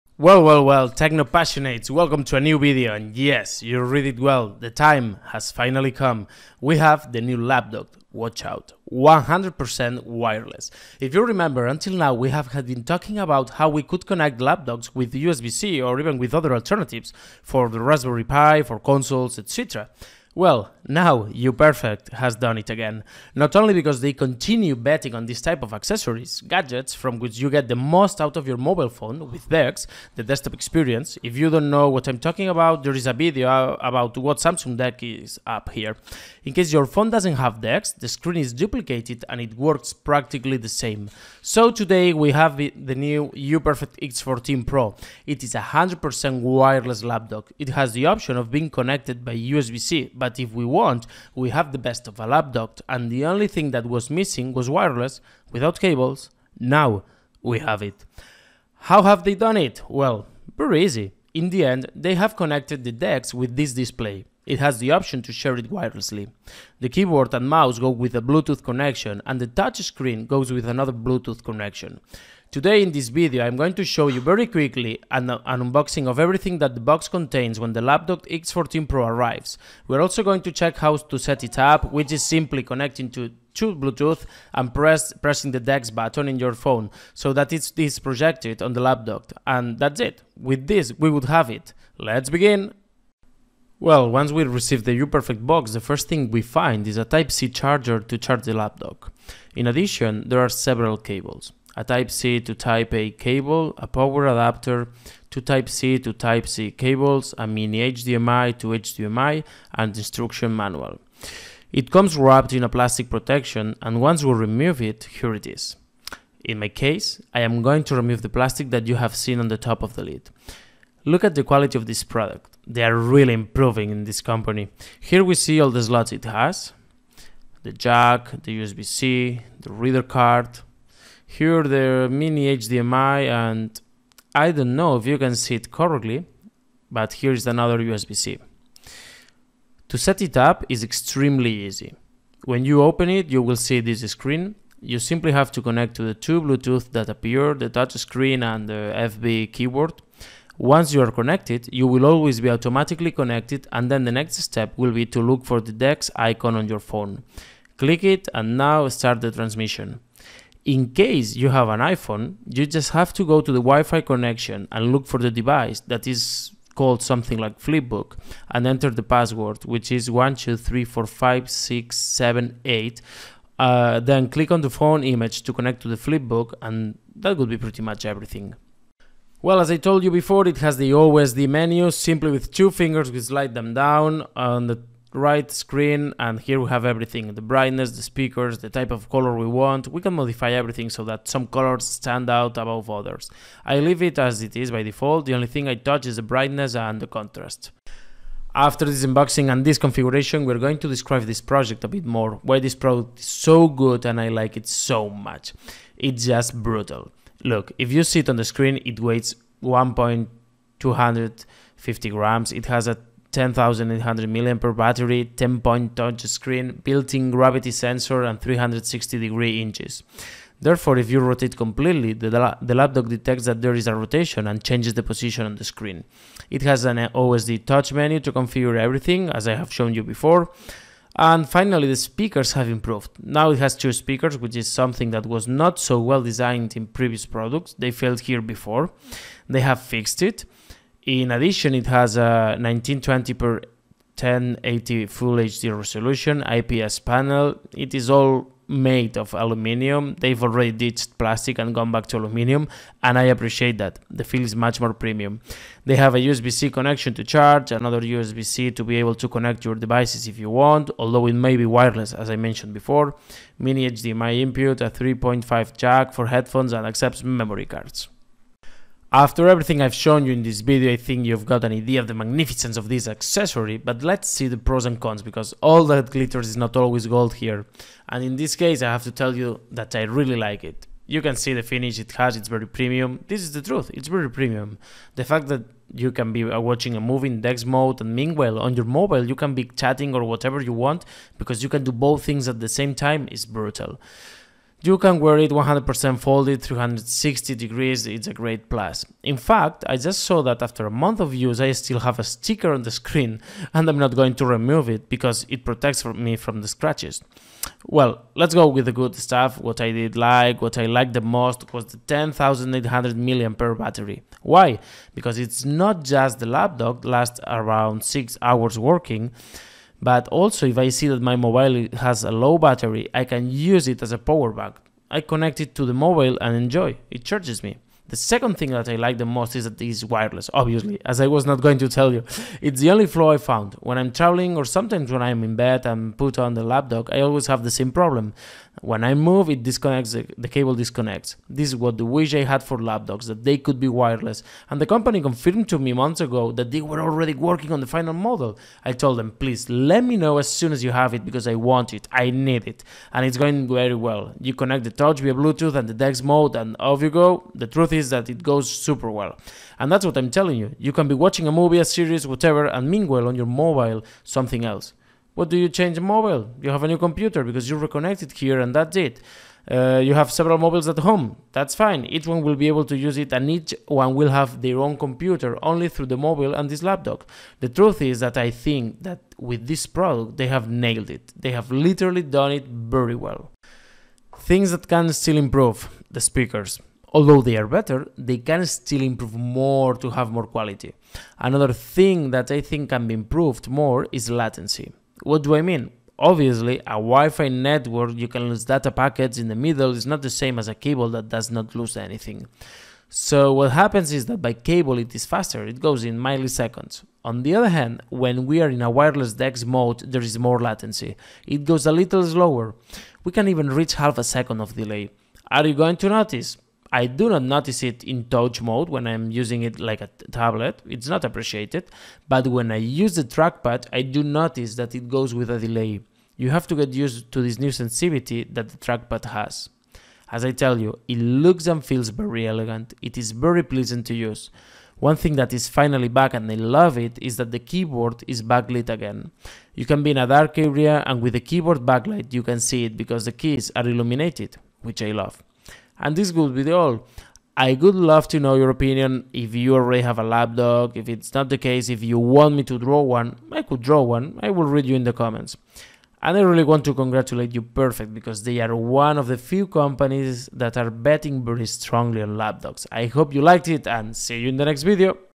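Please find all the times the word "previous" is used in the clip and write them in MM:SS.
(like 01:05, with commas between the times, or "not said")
03:56.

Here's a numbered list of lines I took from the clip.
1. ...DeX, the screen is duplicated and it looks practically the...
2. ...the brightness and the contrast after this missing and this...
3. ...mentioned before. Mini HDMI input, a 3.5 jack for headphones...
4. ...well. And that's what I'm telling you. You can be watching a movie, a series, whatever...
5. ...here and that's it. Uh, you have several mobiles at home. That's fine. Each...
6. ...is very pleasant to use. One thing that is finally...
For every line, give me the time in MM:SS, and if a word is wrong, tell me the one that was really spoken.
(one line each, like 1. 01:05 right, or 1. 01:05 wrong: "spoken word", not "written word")
1. 00:37 wrong: "works", not "looks"
2. 03:16 wrong: "unboxing", not "missing"
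3. 04:22 right
4. 05:59 right
5. 06:08 right
6. 07:13 right.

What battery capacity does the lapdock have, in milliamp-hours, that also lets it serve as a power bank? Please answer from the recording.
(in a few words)
10,800 mAh.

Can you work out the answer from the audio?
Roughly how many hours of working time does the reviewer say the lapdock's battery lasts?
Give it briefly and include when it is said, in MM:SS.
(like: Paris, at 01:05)
6 hours, at 05:18.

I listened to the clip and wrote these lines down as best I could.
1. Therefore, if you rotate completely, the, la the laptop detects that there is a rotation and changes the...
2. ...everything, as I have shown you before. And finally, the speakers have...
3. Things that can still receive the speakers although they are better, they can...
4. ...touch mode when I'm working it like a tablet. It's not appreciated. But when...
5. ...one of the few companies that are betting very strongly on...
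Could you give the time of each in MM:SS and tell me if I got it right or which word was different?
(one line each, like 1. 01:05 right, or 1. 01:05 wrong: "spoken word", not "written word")
1. 03:40 right
2. 03:48 right
3. 06:24 wrong: "improve", not "receive"
4. 06:58 wrong: "using", not "working"
5. 07:38 right.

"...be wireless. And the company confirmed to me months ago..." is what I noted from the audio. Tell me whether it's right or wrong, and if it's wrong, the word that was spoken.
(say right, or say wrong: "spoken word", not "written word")
right.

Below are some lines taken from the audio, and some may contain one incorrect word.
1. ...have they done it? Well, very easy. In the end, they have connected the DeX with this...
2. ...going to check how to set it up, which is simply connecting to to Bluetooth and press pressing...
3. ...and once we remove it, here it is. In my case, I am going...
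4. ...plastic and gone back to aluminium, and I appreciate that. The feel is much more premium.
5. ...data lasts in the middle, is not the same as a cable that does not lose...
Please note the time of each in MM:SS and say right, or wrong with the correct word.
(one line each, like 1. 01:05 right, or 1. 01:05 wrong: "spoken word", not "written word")
1. 00:59 right
2. 01:20 right
3. 01:53 right
4. 04:11 right
5. 06:38 wrong: "packets", not "lasts".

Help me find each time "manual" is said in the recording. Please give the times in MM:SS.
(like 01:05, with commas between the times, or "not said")
01:50.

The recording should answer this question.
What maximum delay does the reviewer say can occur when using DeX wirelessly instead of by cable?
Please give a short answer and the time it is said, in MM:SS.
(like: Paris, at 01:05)
half a second, at 06:53.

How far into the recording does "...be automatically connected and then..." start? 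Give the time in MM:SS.
02:32.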